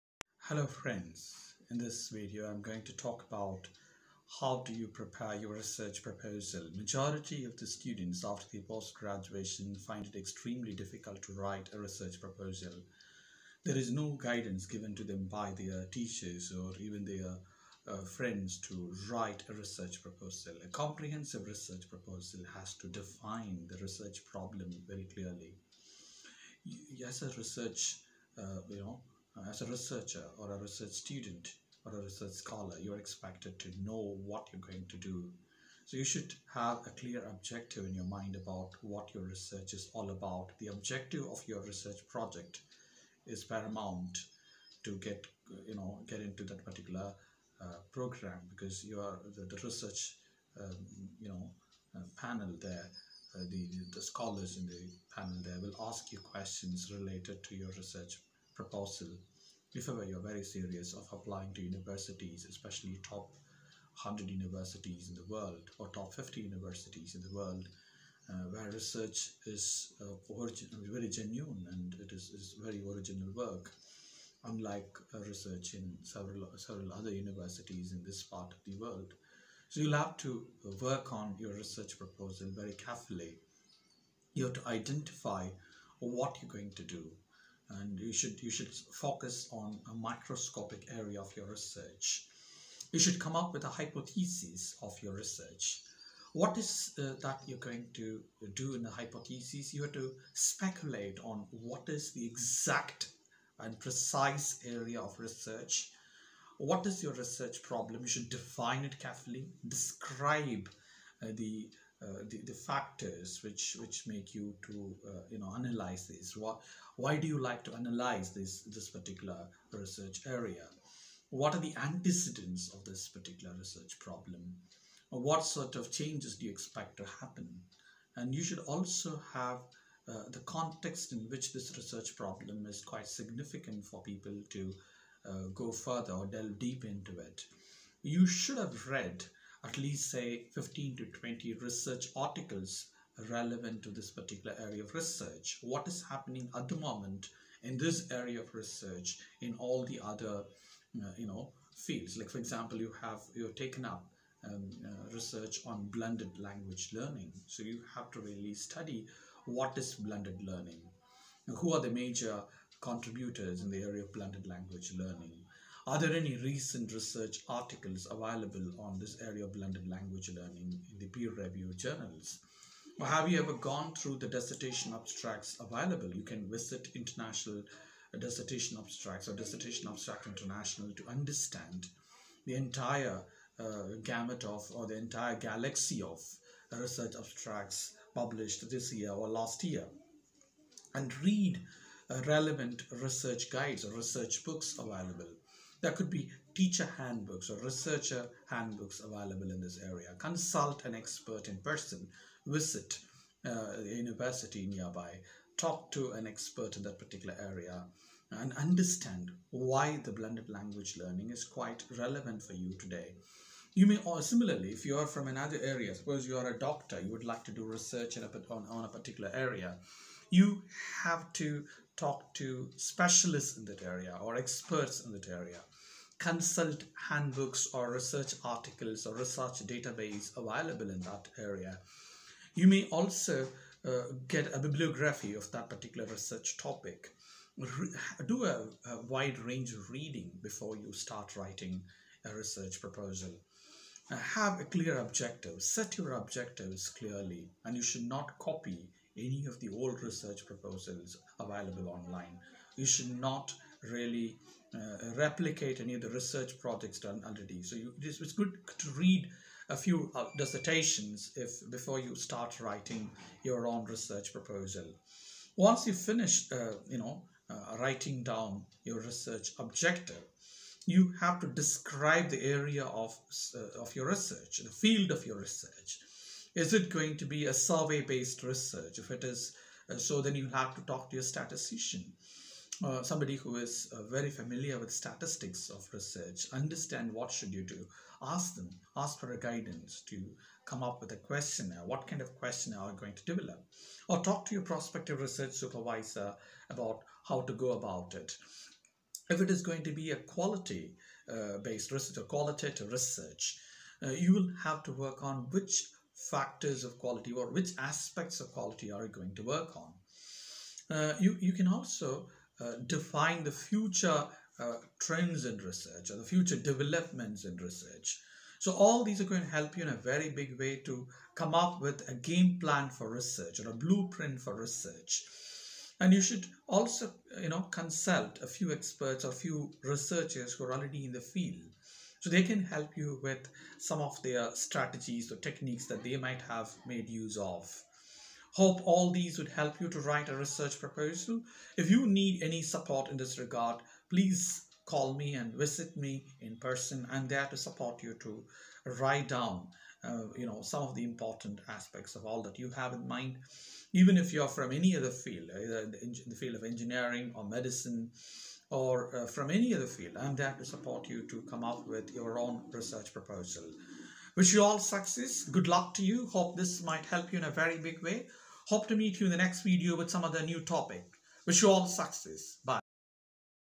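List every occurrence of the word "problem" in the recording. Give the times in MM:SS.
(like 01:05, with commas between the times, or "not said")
00:24, 01:47, 02:03, 02:12.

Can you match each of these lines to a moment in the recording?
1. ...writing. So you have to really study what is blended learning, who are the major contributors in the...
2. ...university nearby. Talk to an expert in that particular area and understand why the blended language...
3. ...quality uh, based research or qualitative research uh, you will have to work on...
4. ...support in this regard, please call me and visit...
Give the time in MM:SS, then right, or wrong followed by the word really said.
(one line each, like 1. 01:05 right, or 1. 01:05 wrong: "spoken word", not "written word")
1. 02:36 wrong: "learning", not "writing"
2. 03:23 right
3. 05:00 right
4. 05:42 right.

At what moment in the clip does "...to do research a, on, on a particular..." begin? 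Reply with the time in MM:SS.
03:37.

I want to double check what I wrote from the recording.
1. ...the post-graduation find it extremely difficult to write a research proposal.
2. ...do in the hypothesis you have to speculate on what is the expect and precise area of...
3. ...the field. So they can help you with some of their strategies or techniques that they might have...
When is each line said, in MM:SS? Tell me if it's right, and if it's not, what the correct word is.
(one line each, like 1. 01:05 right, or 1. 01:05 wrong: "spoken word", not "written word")
1. 00:08 right
2. 01:38 wrong: "exact", not "expect"
3. 05:31 right.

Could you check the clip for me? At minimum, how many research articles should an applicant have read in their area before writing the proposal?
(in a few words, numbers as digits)
15 to 20.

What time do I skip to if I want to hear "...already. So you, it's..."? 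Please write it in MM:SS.
04:17.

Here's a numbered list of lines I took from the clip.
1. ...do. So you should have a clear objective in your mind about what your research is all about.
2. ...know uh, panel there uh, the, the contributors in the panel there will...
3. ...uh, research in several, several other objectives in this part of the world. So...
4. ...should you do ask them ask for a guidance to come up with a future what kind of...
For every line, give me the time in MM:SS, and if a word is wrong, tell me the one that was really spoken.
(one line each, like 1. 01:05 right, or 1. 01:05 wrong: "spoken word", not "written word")
1. 00:34 right
2. 00:51 wrong: "scholars", not "contributors"
3. 01:15 wrong: "universities", not "objectives"
4. 04:47 wrong: "questionnaire", not "future".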